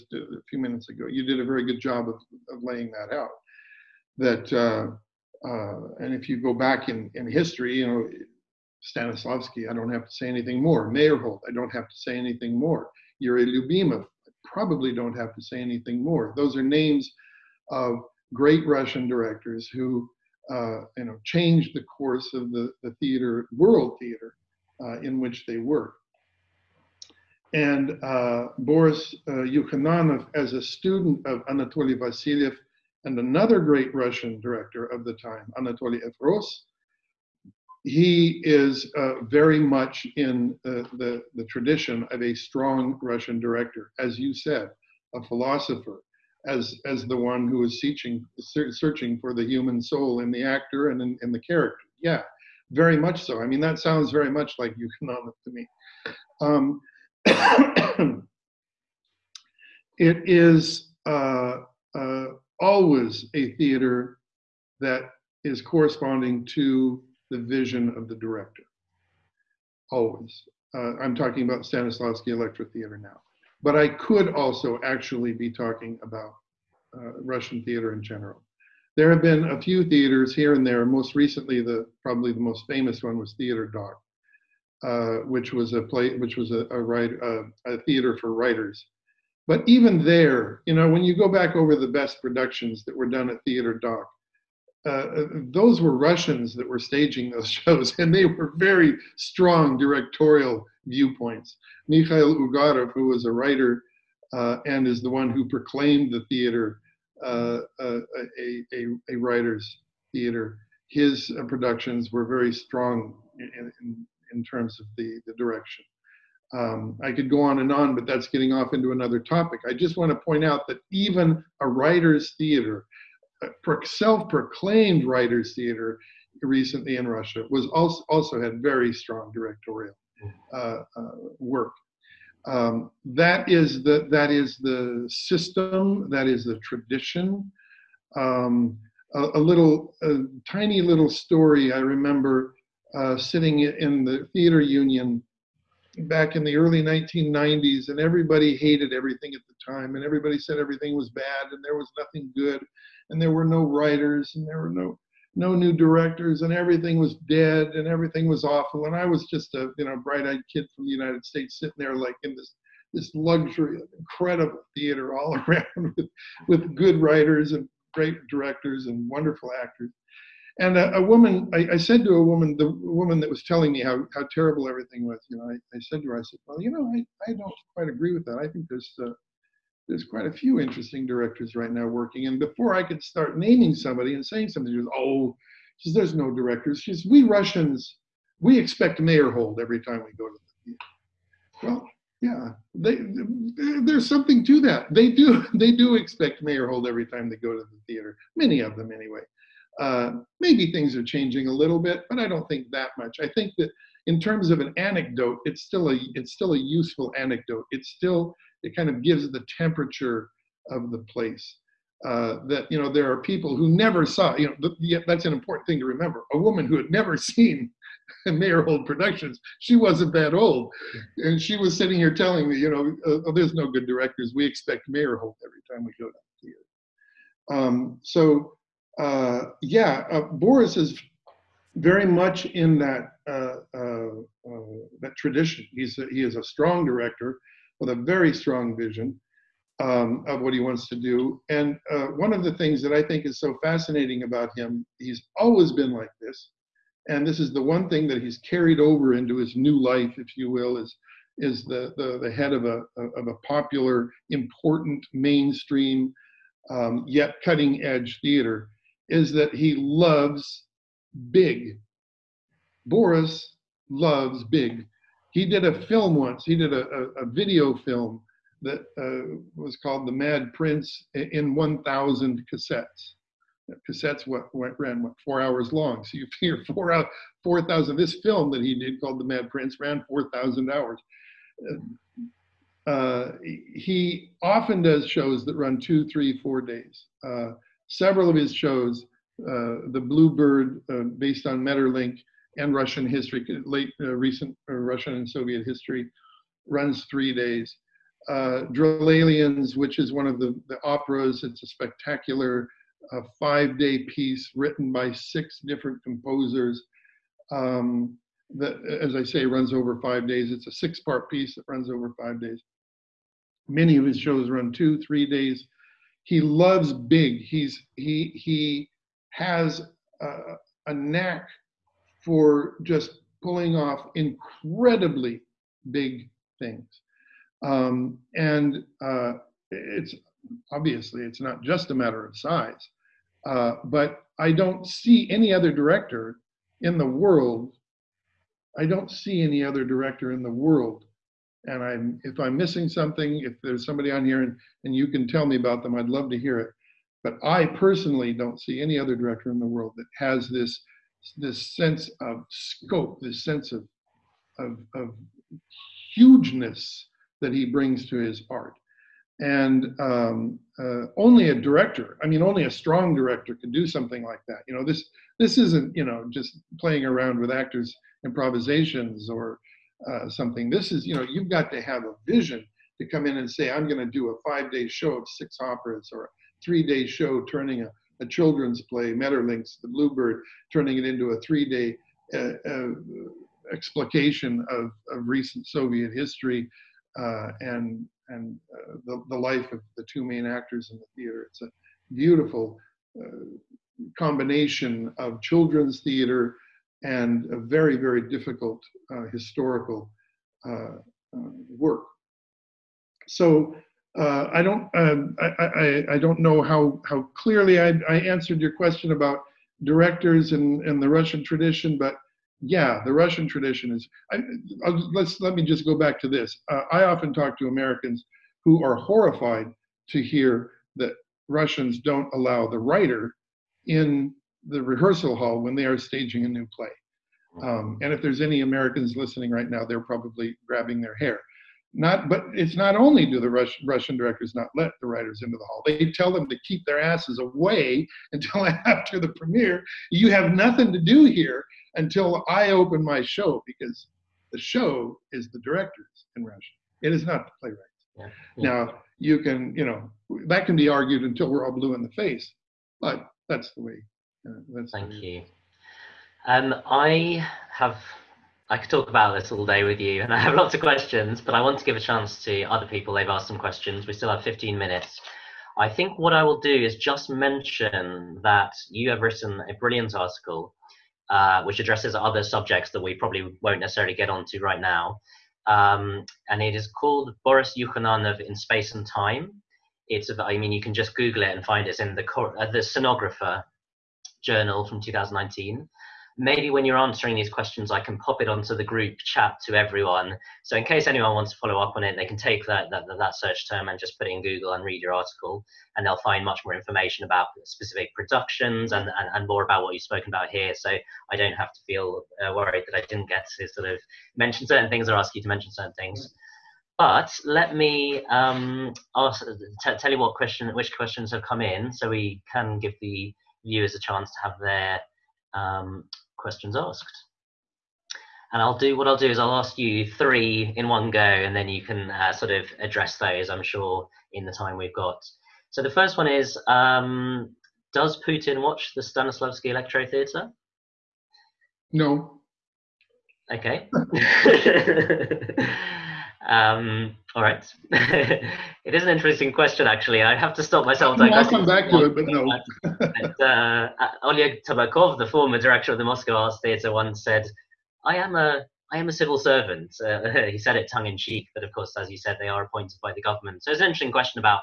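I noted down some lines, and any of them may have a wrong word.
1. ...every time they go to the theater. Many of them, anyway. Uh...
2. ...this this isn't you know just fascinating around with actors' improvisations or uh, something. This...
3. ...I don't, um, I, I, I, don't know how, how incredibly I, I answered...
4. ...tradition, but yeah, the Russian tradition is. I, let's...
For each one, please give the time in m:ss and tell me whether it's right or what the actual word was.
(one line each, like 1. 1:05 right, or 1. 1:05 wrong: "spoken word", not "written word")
1. 3:16 right
2. 6:04 wrong: "playing", not "fascinating"
3. 6:44 wrong: "clearly", not "incredibly"
4. 6:51 right.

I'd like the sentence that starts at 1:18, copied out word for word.
There have been a few theaters here and there.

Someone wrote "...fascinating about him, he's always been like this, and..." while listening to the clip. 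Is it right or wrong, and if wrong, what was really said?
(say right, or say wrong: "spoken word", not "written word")
right.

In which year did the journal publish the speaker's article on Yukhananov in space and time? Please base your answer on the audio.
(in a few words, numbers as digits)
2019.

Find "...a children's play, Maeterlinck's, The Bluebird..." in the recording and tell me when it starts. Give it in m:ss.
6:18.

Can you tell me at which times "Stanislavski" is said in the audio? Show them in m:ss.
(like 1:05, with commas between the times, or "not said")
0:08, 1:11, 8:49.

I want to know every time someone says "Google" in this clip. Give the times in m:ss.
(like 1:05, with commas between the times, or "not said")
8:01, 8:14.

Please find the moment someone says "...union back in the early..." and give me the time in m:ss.
2:24.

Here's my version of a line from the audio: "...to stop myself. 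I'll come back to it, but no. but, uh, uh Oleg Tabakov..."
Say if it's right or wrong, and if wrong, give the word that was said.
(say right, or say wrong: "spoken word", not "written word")
right.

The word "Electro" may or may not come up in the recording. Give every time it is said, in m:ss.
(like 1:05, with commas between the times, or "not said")
1:12, 8:49.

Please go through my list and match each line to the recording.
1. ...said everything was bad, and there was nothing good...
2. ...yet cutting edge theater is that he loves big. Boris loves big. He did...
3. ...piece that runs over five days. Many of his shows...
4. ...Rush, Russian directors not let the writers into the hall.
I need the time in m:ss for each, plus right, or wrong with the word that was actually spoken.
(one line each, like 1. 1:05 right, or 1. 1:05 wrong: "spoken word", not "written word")
1. 2:30 right
2. 4:17 right
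3. 5:11 right
4. 7:13 right.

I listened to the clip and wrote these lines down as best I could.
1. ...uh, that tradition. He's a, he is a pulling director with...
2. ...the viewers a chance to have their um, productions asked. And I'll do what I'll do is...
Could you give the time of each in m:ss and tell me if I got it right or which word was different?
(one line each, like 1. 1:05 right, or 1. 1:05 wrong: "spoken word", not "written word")
1. 3:54 wrong: "strong", not "pulling"
2. 8:33 wrong: "questions", not "productions".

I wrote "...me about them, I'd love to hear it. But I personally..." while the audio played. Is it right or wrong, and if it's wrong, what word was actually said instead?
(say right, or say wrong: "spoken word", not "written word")
right.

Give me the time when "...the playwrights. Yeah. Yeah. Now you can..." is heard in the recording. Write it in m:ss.
7:27.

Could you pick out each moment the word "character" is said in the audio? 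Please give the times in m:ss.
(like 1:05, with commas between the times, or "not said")
0:51.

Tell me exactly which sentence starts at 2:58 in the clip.
I think there's uh, there's quite a few interesting directors right now working.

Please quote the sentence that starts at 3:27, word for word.
It's still it kind of gives the temperature of the place.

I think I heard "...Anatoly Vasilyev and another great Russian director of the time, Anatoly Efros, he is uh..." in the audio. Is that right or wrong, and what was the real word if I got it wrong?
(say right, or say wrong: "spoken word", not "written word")
right.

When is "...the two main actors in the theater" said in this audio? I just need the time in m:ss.
6:29.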